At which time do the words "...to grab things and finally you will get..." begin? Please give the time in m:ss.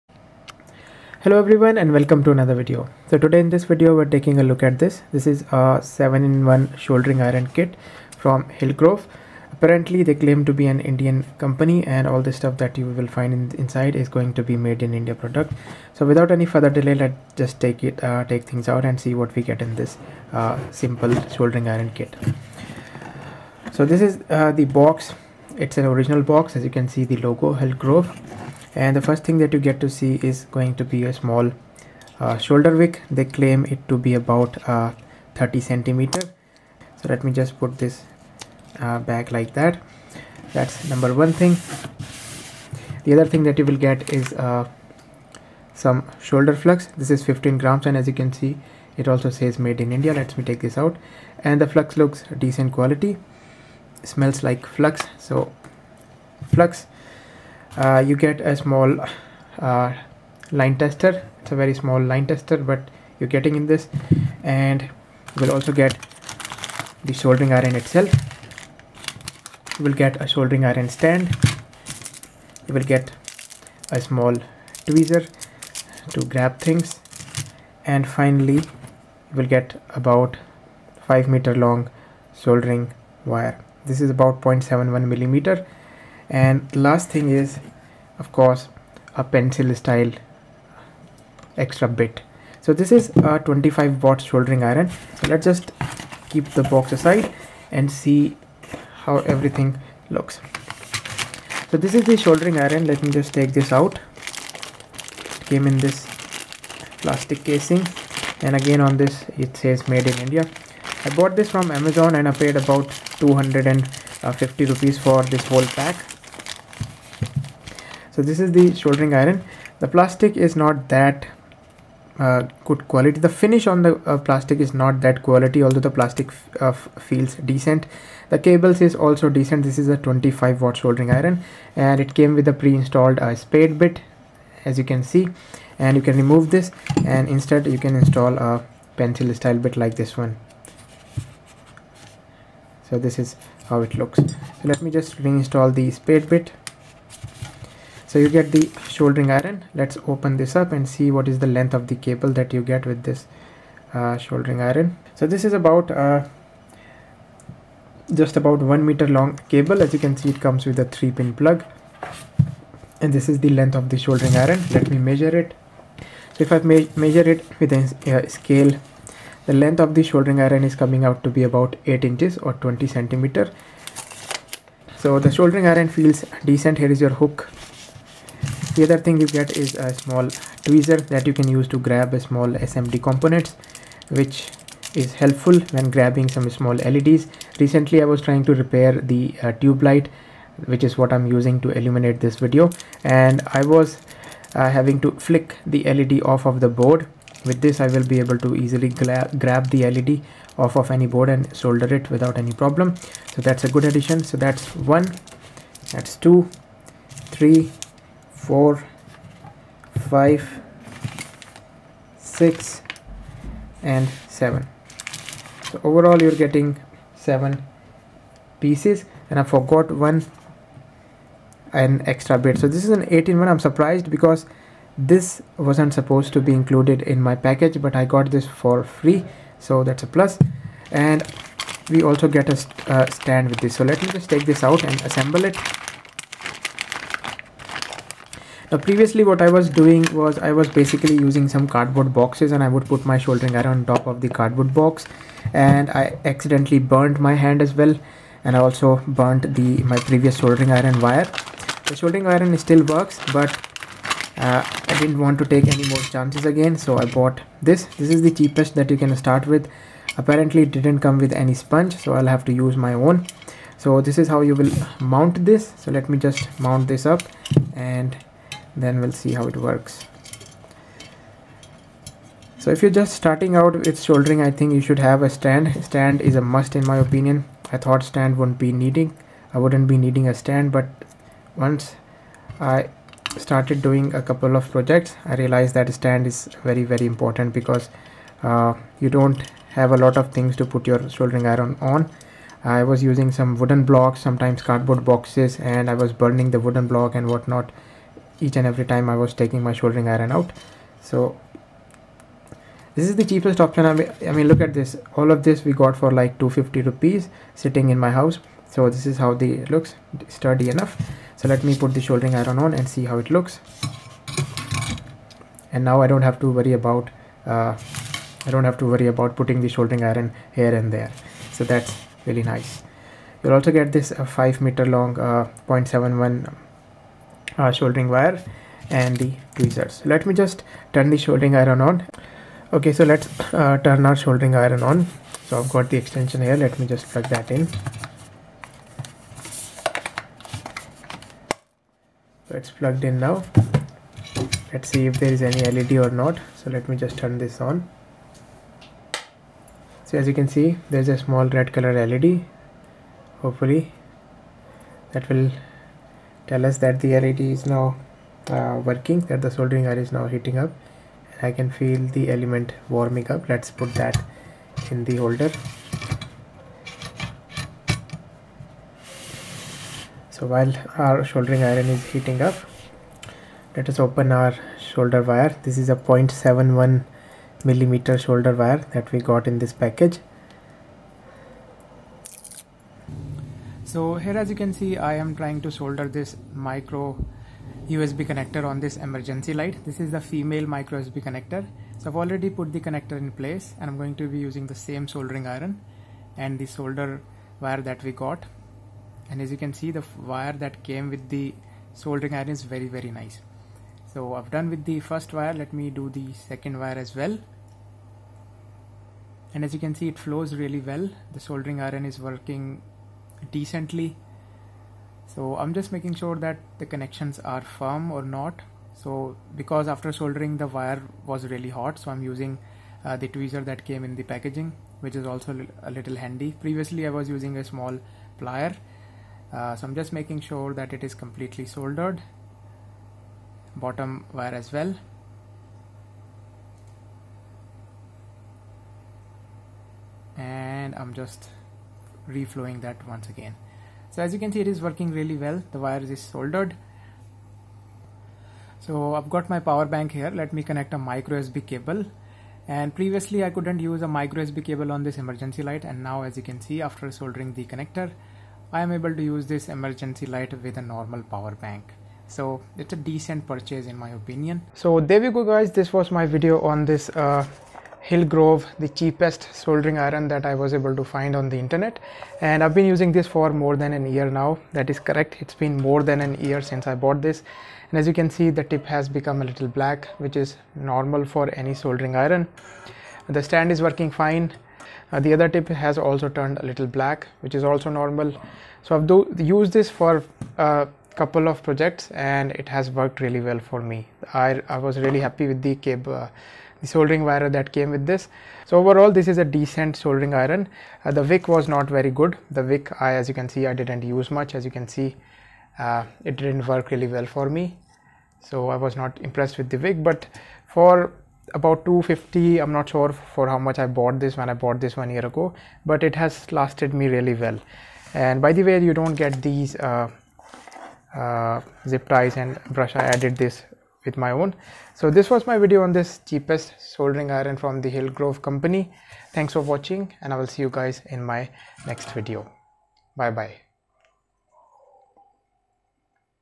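1:16.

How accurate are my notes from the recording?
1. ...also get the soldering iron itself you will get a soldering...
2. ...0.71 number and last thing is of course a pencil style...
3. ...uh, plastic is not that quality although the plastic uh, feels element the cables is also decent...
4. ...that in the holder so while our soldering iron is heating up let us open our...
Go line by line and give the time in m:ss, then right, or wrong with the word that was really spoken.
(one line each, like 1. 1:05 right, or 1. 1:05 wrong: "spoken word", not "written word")
1. 1:05 right
2. 1:24 wrong: "millimeter", not "number"
3. 2:04 wrong: "decent", not "element"
4. 6:03 right.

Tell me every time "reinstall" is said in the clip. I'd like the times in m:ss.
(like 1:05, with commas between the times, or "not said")
2:25.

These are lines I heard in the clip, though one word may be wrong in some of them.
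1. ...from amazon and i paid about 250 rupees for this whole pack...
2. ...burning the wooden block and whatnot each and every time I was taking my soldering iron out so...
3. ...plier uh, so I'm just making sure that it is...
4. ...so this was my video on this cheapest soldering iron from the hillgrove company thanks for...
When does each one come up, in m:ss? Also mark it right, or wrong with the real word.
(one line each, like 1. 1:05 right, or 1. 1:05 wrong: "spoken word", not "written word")
1. 1:51 right
2. 4:56 right
3. 7:08 right
4. 8:44 right.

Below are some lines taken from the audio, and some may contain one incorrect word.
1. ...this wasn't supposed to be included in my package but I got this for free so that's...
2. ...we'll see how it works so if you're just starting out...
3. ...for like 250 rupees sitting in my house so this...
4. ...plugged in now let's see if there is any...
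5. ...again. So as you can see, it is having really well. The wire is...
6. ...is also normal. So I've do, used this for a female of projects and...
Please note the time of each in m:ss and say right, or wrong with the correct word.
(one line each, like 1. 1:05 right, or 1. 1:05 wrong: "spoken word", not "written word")
1. 3:44 right
2. 4:29 right
3. 5:05 right
4. 5:42 right
5. 7:23 wrong: "working", not "having"
6. 8:07 wrong: "couple", not "female".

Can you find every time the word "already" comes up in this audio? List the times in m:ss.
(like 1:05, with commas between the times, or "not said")
6:32.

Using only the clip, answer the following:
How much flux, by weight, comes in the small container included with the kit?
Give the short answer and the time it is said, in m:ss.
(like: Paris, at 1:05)
15 grams, at 0:47.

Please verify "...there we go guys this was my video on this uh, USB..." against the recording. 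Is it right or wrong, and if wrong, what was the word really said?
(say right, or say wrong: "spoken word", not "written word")
wrong: "Hillgrove", not "USB".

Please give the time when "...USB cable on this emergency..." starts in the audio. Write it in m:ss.
7:34.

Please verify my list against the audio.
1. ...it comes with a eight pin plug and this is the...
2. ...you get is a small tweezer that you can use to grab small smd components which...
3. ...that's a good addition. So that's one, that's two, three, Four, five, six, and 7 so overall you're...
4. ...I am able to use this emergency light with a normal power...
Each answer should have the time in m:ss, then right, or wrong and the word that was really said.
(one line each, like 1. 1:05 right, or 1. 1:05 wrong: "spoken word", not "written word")
1. 2:40 wrong: "three", not "eight"
2. 2:59 right
3. 3:23 right
4. 7:38 right.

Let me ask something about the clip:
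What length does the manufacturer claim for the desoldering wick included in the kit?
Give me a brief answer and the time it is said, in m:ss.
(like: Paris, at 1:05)
30 centimeters, at 0:35.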